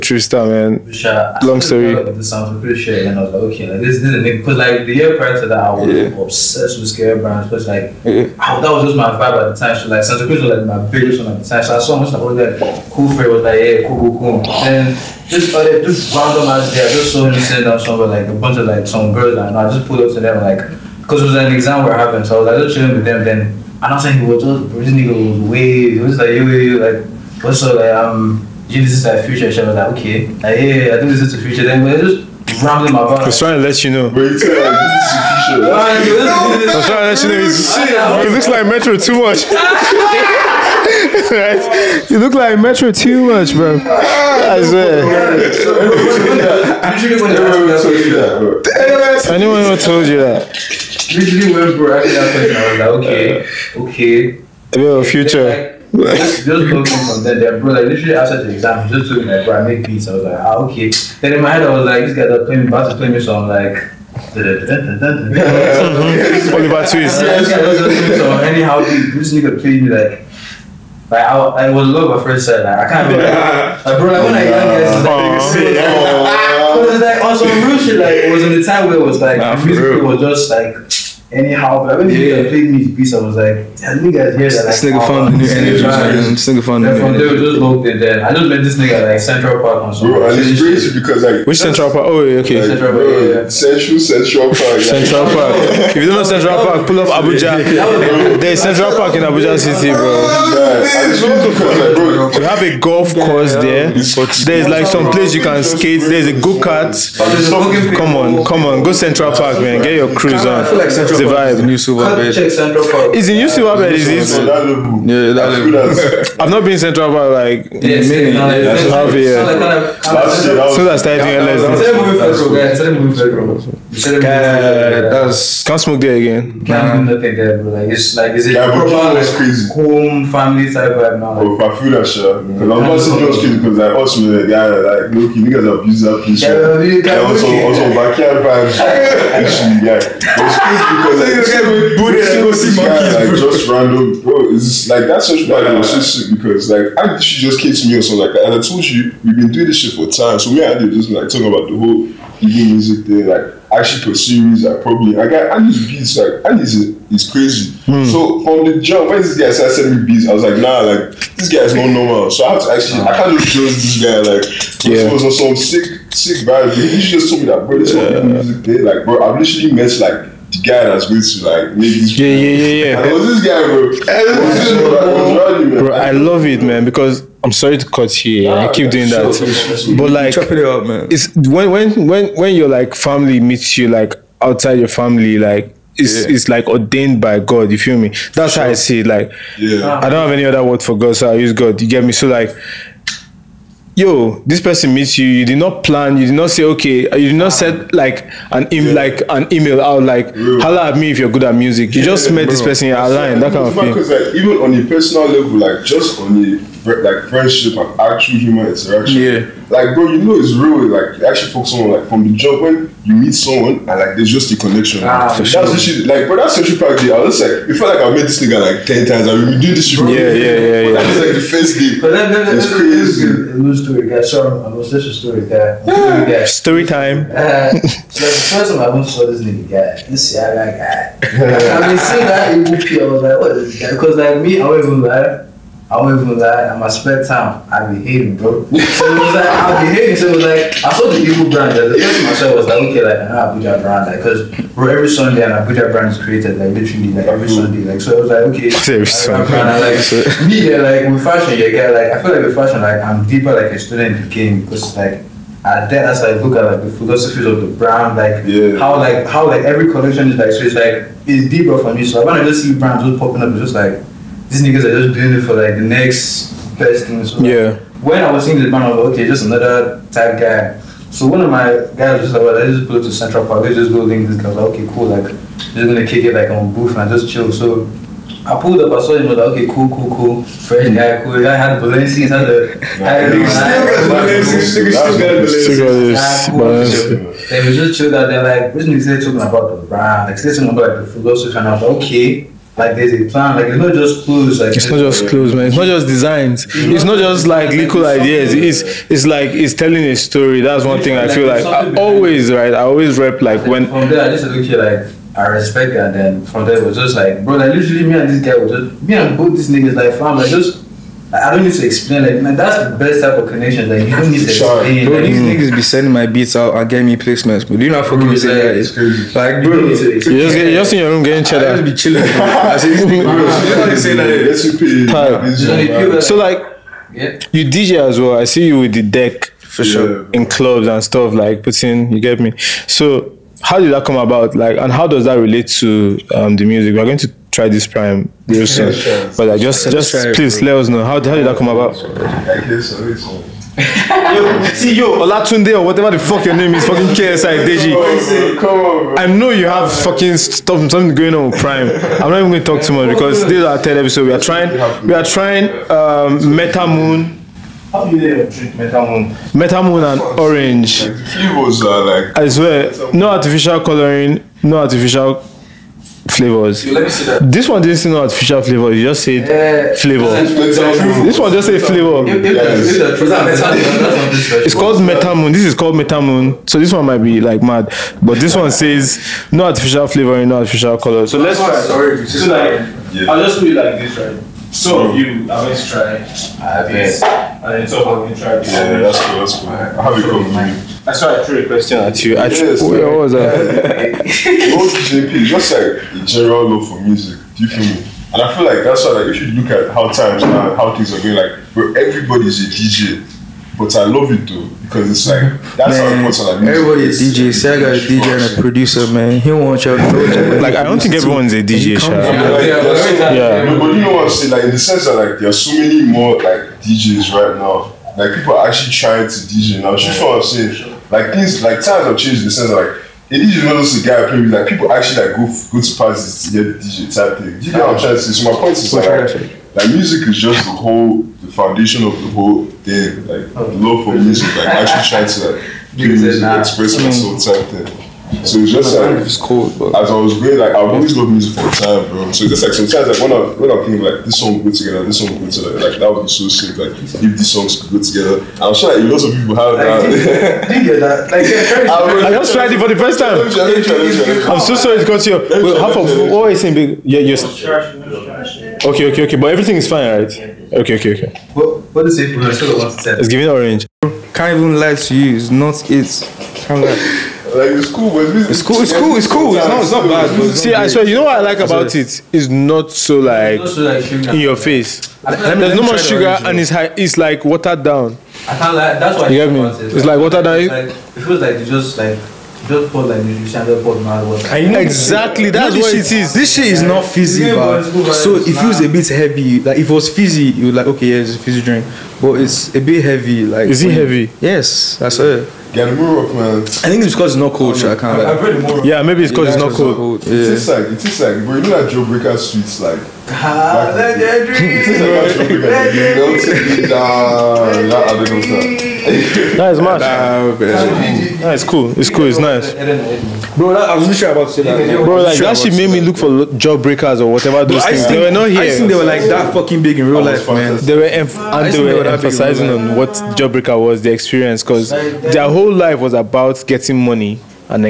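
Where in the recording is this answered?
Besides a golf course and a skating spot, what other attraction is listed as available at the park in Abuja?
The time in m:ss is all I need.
1:46.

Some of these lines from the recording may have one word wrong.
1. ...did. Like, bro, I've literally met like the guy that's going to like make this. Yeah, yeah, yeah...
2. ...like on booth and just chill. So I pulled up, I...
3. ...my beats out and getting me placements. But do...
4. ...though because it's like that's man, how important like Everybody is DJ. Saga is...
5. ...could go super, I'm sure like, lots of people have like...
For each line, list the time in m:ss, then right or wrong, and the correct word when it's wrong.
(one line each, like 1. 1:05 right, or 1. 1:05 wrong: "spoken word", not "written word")
1. 2:48 right
2. 4:36 right
3. 5:16 right
4. 6:44 right
5. 7:27 wrong: "together", not "super".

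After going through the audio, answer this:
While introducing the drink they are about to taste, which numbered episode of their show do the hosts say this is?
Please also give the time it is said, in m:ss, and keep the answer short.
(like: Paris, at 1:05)
Third, at 5:53.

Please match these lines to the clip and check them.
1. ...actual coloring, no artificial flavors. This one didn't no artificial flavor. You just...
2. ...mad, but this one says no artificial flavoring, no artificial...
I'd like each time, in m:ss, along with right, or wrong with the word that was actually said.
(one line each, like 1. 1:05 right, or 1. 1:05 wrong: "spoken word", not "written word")
1. 6:03 wrong: "artificial", not "actual"
2. 6:17 right.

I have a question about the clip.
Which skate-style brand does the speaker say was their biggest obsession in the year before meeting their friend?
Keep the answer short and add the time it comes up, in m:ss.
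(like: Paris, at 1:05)
Santa Cruz, at 0:10.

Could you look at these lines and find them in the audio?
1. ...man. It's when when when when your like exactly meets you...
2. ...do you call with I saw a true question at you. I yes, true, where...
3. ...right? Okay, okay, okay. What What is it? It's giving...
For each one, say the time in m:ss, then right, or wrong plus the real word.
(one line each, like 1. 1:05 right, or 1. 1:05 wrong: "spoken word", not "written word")
1. 3:00 wrong: "family", not "exactly"
2. 6:30 right
3. 7:40 right.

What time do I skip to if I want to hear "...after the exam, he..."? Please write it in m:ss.
0:58.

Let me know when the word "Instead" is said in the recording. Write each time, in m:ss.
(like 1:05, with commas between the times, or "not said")
2:01.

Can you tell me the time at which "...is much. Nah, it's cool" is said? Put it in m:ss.
8:29.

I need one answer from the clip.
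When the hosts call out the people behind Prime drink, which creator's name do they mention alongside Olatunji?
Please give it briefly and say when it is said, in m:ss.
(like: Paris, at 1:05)
KSI, at 5:47.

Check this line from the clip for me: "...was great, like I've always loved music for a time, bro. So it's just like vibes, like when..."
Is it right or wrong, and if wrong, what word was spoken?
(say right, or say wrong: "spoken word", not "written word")
wrong: "sometimes", not "vibes".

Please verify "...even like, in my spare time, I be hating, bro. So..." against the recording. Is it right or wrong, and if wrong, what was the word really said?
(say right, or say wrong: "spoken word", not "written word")
right.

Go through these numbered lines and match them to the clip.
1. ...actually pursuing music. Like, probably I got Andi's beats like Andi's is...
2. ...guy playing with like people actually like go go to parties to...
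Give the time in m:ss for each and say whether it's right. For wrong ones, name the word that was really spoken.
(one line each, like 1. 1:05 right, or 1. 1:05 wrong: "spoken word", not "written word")
1. 2:33 right
2. 7:04 right.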